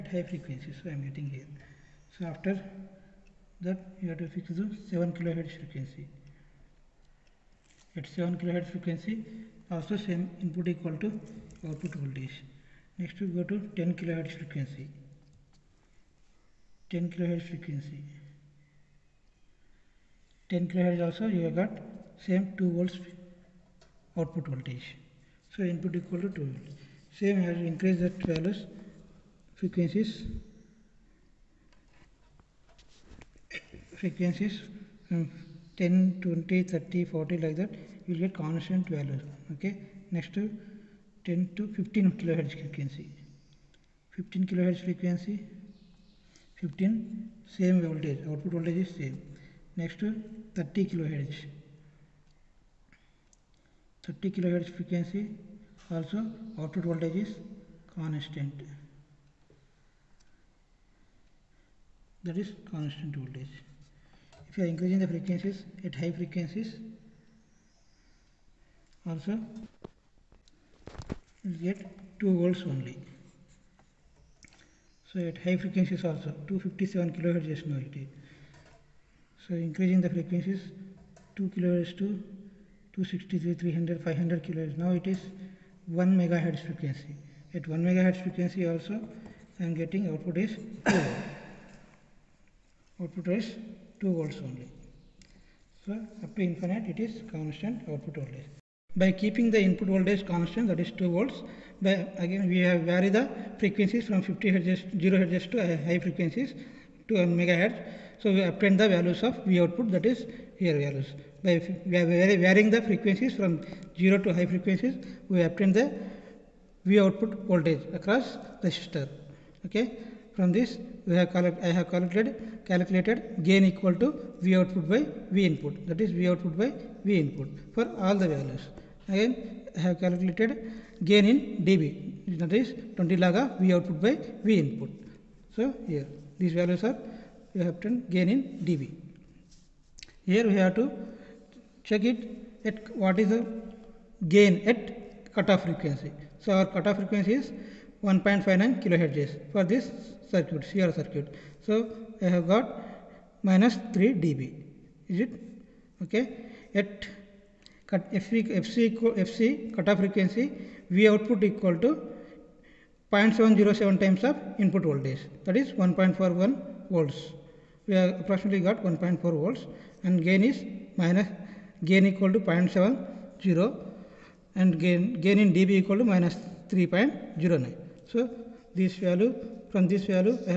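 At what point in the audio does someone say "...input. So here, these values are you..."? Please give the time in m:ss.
2:14.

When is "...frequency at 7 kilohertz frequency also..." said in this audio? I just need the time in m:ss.
0:05.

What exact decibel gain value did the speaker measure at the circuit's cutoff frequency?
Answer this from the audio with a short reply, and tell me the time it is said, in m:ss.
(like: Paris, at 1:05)
-3.09, at 2:56.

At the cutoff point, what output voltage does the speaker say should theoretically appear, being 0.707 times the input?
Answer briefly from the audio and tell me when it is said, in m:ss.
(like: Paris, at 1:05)
1.41 volts, at 2:45.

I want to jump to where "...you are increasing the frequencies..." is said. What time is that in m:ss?
1:04.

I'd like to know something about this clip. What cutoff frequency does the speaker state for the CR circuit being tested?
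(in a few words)
1.59 kilohertz.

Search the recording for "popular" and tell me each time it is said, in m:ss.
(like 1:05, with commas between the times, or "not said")
not said.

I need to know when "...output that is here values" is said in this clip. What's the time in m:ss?
1:49.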